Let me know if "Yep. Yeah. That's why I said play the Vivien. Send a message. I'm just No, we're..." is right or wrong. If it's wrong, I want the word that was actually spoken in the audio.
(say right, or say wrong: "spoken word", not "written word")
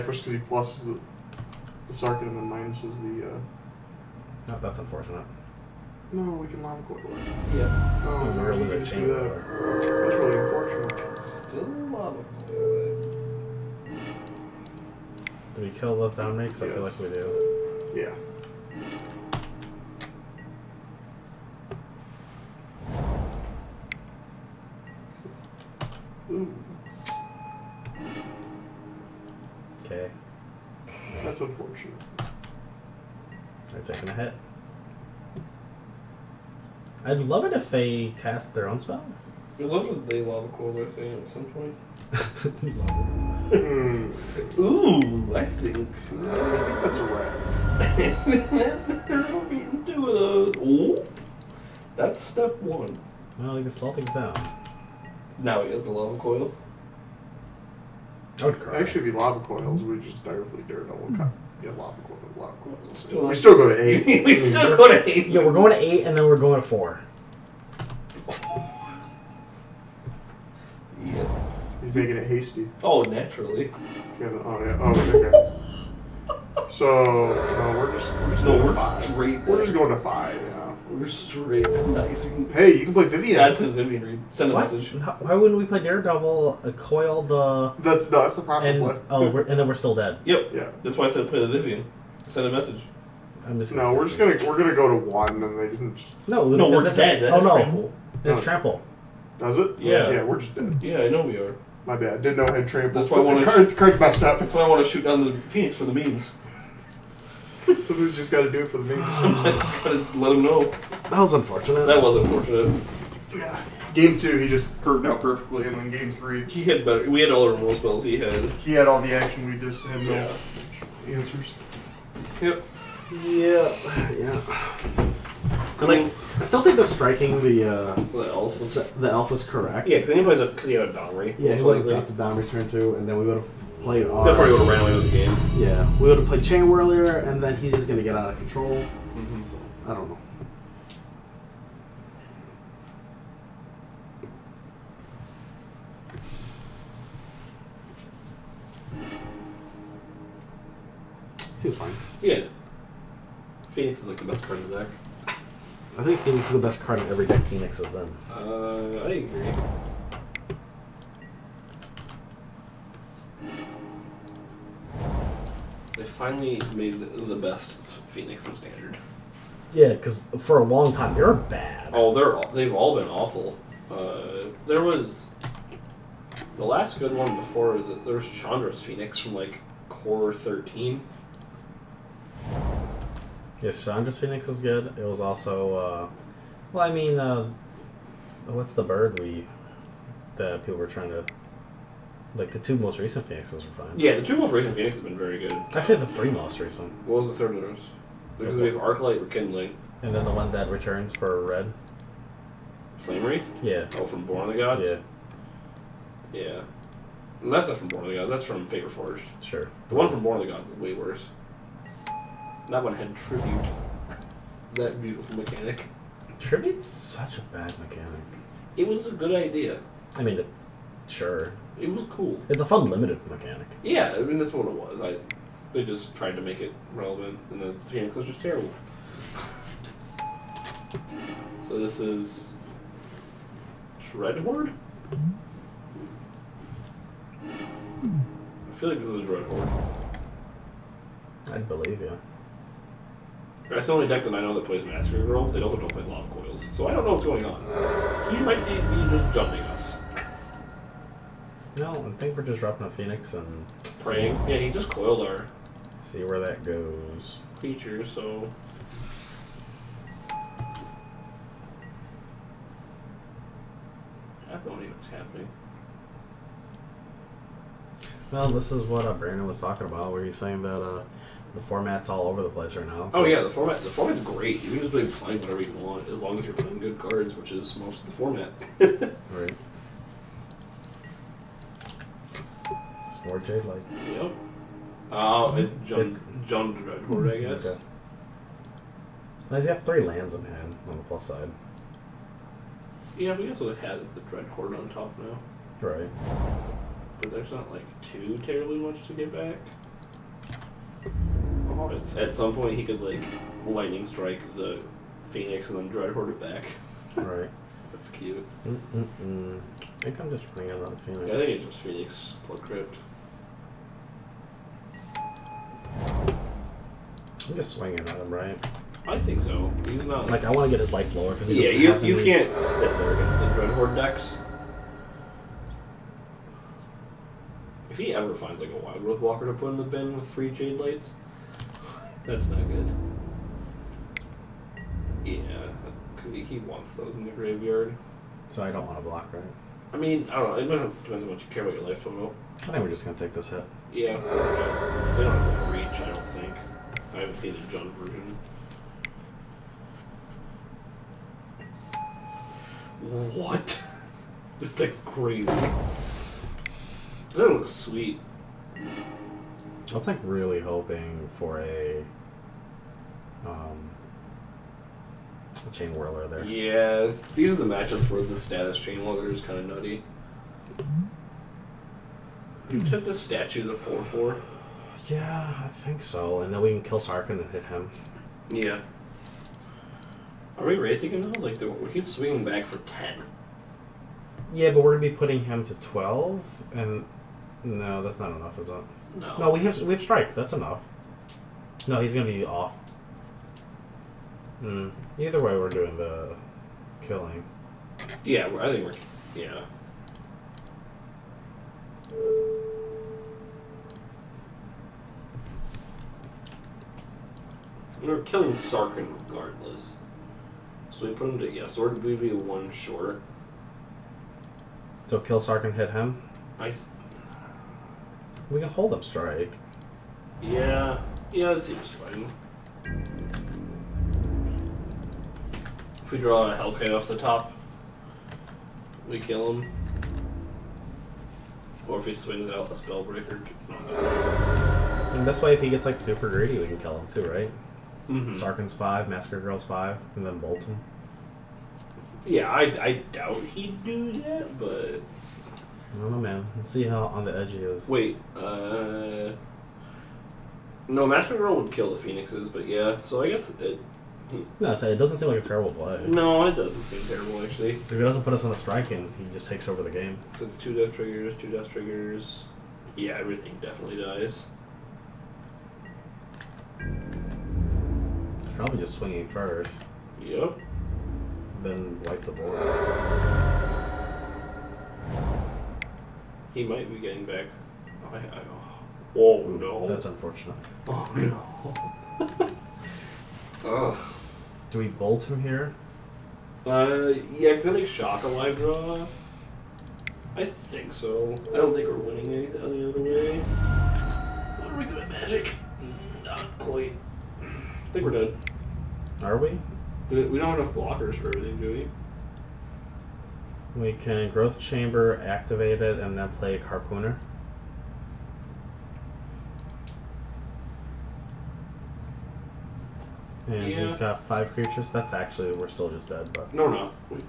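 right.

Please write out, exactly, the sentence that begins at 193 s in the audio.
Yeah, the two most recent Phoenixes have been very good.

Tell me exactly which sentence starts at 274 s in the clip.
You can just be playing whatever you want as long as you're playing good cards, which is most of the format.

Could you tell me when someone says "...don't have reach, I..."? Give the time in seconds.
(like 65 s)
345 s.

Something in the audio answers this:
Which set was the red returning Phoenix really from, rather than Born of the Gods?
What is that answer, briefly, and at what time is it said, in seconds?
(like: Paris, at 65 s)
Fate Reforged, at 208 s.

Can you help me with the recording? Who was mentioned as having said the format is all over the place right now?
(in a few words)
Brandon.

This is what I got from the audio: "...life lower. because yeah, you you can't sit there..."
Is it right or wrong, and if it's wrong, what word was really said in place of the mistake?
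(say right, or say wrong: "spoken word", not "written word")
right.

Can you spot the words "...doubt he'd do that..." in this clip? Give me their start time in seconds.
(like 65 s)
443 s.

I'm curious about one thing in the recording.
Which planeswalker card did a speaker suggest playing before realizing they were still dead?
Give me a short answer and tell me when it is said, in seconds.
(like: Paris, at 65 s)
Vivien Reid, at 83 s.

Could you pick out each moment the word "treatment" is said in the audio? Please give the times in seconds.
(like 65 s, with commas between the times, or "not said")
not said.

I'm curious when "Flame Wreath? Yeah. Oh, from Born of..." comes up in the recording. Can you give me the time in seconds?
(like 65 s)
202 s.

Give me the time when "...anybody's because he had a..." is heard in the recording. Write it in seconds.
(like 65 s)
130 s.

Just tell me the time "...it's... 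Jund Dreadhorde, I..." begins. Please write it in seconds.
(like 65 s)
286 s.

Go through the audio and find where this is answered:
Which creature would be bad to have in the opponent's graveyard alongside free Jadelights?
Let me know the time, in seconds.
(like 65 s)
328 s.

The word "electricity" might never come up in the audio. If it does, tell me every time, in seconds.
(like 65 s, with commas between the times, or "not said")
not said.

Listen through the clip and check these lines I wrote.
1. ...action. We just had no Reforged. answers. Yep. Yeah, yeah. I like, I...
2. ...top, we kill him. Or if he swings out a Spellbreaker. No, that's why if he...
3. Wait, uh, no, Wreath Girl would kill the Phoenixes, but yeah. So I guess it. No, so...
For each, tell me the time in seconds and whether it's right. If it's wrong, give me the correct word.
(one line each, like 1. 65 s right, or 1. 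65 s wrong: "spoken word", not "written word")
1. 119 s wrong: "Yeah", not "Reforged"
2. 427 s right
3. 447 s wrong: "Massacre", not "Wreath".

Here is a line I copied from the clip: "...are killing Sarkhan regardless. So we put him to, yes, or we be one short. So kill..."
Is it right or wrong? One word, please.
right.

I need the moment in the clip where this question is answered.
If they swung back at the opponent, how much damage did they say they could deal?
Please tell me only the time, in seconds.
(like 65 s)
382 s.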